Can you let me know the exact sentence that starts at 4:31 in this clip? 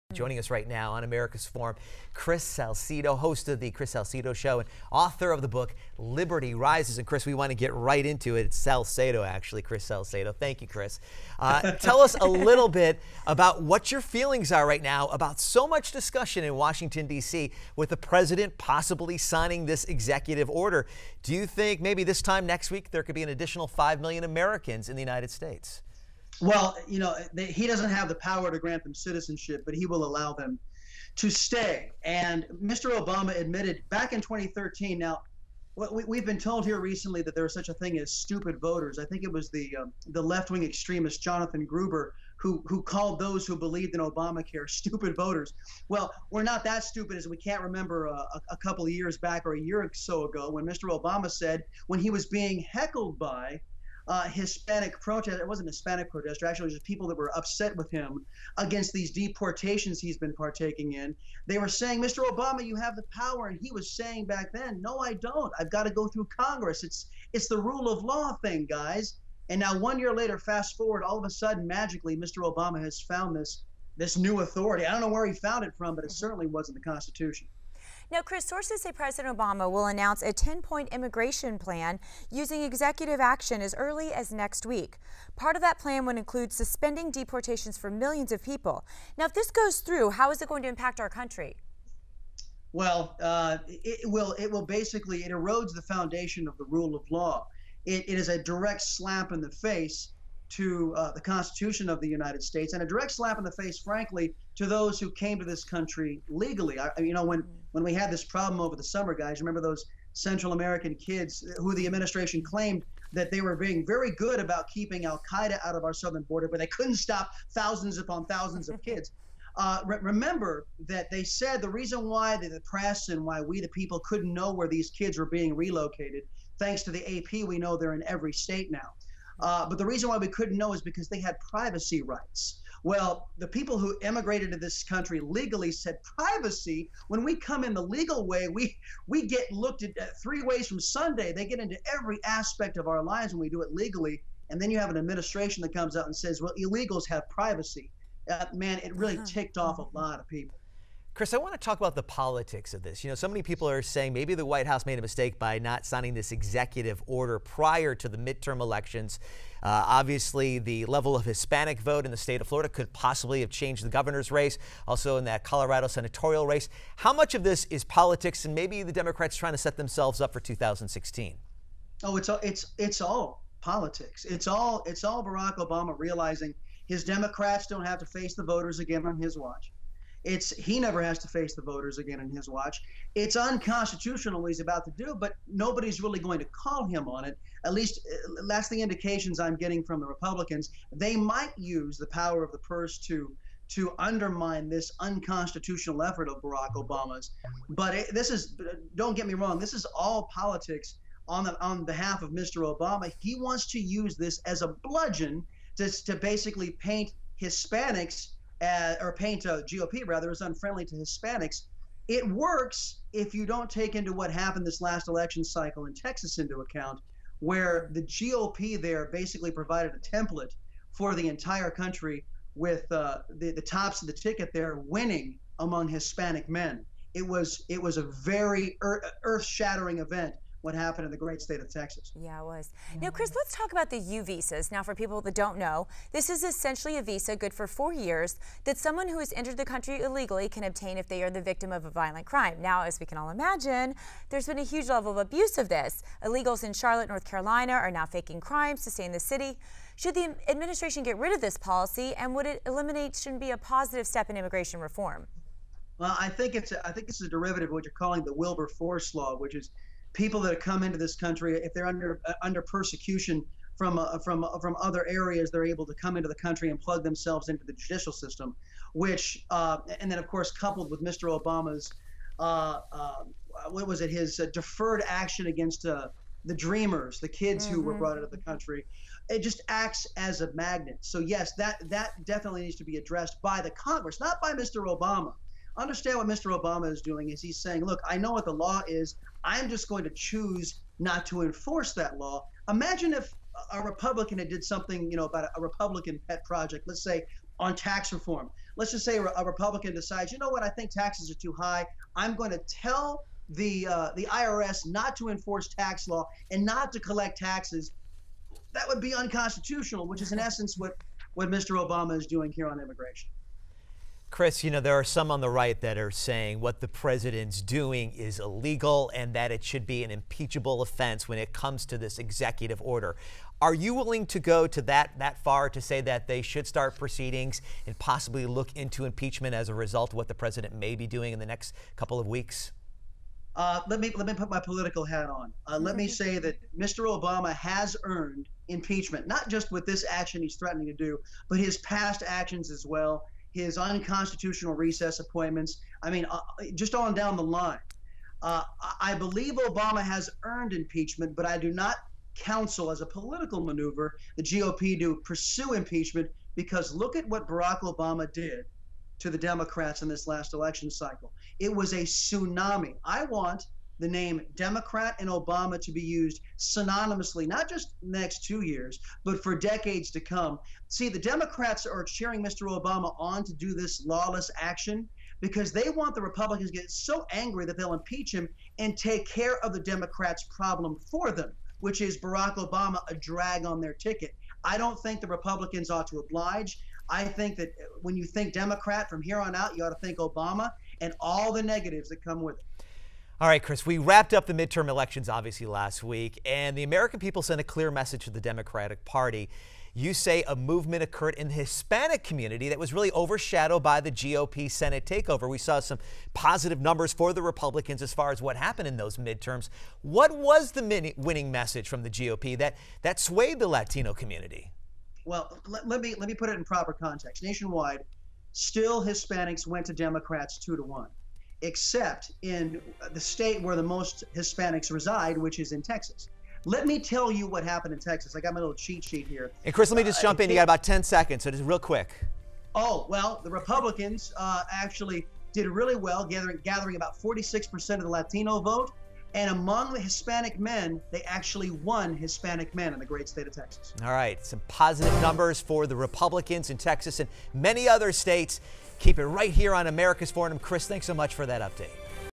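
Obama's uh, uh, what was it his deferred action against the dreamers, the kids mm-hmm.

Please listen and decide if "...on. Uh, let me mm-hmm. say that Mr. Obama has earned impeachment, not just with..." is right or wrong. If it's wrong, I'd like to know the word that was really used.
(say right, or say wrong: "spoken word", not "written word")
right.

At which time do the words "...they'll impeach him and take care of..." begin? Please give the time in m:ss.
6:17.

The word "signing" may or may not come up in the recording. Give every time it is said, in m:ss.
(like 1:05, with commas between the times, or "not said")
0:19, 2:35.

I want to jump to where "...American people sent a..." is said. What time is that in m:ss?
6:36.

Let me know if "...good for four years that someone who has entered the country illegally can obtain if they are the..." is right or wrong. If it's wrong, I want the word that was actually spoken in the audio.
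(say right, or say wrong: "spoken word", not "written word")
right.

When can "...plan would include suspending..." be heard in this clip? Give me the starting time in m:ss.
1:25.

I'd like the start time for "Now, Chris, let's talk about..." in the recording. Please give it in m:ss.
3:53.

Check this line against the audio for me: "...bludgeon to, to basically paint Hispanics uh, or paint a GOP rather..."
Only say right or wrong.
right.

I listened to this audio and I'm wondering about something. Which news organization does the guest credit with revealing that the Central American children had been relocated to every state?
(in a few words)
AP.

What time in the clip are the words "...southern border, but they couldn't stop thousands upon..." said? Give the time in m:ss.
1:55.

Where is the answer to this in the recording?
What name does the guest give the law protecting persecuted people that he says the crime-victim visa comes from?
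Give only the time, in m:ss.
4:18.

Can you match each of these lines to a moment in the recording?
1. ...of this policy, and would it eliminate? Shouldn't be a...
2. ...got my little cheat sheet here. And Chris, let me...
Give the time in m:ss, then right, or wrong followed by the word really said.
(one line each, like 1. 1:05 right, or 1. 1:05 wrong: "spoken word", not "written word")
1. 4:11 right
2. 7:08 right.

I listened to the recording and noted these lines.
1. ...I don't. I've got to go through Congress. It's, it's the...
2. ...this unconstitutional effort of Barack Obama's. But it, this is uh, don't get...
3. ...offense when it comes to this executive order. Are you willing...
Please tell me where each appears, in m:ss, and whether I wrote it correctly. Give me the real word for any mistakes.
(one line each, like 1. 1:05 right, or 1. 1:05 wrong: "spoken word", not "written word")
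1. 1:04 right
2. 3:14 right
3. 5:20 right.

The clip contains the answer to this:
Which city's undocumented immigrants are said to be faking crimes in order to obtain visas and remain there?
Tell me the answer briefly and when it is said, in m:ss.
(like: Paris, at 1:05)
Charlotte, North Carolina, at 4:06.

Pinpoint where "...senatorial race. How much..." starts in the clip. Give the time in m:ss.
2:45.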